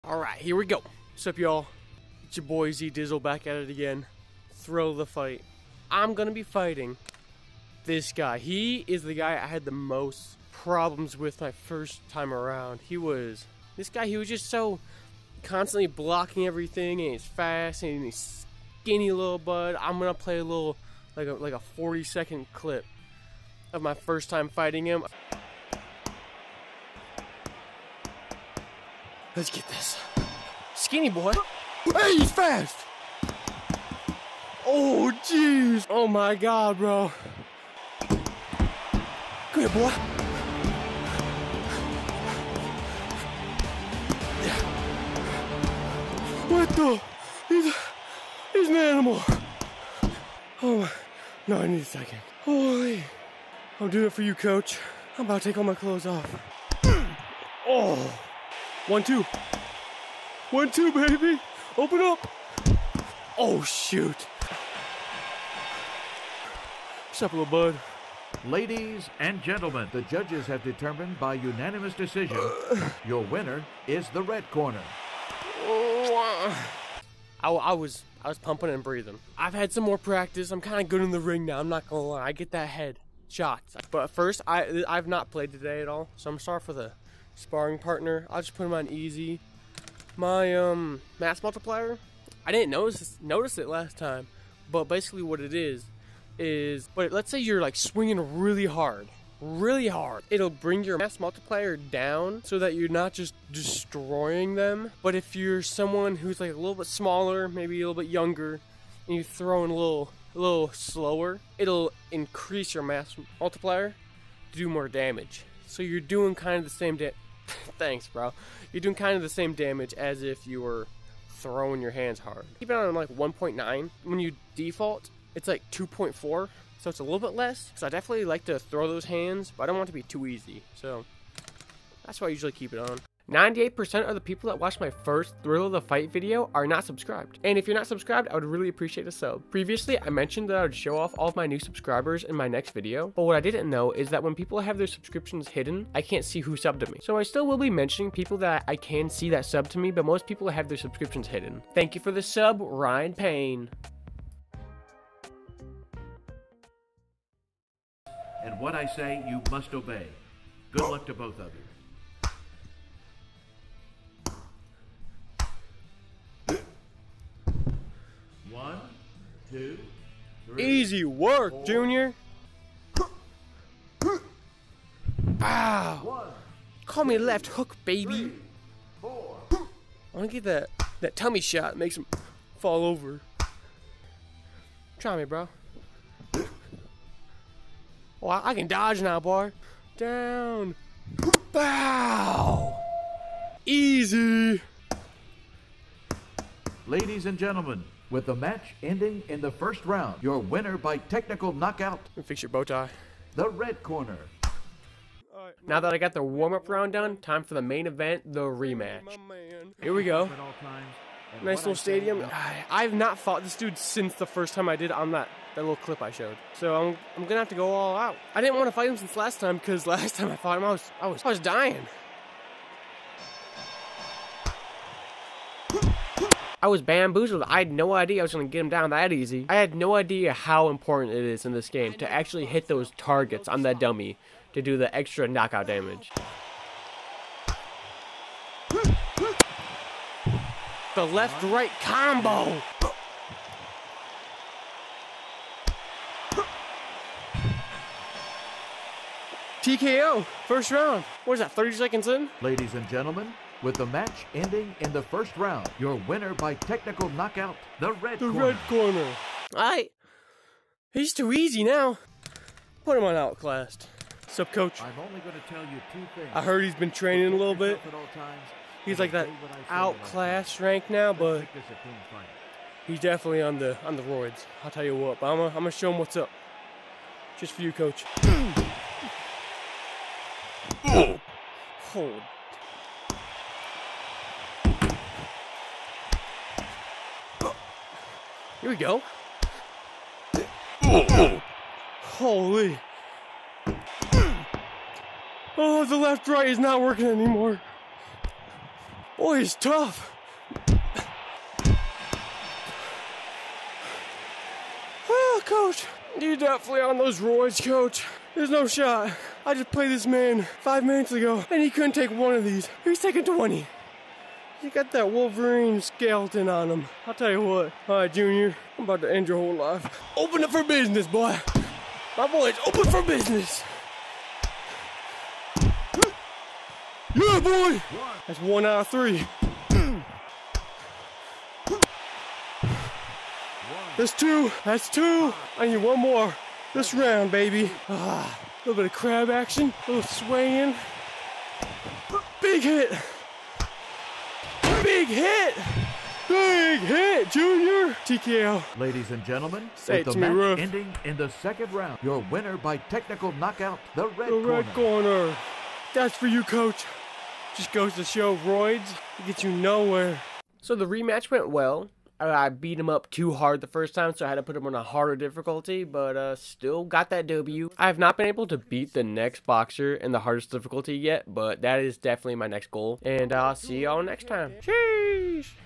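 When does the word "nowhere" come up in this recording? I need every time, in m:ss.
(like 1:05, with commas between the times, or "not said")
5:59.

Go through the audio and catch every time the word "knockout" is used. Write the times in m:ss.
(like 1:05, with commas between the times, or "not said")
3:21, 3:55, 4:17, 5:53.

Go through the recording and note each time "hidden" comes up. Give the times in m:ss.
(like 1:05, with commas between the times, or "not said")
2:25, 2:31.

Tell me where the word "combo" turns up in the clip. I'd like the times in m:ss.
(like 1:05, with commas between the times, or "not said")
4:01.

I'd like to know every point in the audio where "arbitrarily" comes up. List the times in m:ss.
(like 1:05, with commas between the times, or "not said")
not said.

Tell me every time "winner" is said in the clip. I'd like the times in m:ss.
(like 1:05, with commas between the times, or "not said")
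1:13, 3:20, 4:16, 5:52.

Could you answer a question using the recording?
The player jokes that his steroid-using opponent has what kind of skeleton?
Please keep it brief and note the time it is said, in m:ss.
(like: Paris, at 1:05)
Wolverine skeleton, at 5:15.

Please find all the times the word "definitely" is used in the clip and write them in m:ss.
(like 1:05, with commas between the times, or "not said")
2:07, 4:32, 5:06, 6:11.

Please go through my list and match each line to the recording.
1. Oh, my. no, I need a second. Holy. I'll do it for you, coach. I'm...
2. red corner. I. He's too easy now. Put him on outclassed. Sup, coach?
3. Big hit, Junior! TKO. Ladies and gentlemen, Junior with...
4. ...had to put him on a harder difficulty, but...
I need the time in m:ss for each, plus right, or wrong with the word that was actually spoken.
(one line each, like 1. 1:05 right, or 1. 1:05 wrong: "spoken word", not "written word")
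1. 0:50 right
2. 4:18 right
3. 5:46 wrong: "Say", not "Junior"
4. 6:04 right.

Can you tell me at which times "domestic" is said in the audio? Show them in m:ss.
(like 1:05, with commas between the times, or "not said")
not said.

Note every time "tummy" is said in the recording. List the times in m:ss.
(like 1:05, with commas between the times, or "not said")
3:01.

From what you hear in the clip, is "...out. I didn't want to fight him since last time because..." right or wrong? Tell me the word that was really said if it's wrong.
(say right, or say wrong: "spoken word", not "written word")
right.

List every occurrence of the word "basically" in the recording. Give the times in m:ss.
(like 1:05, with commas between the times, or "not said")
1:34.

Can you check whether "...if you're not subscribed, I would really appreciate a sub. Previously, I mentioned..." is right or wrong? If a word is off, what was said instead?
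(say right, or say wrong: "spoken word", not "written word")
right.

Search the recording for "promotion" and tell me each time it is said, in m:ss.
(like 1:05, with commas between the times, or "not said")
not said.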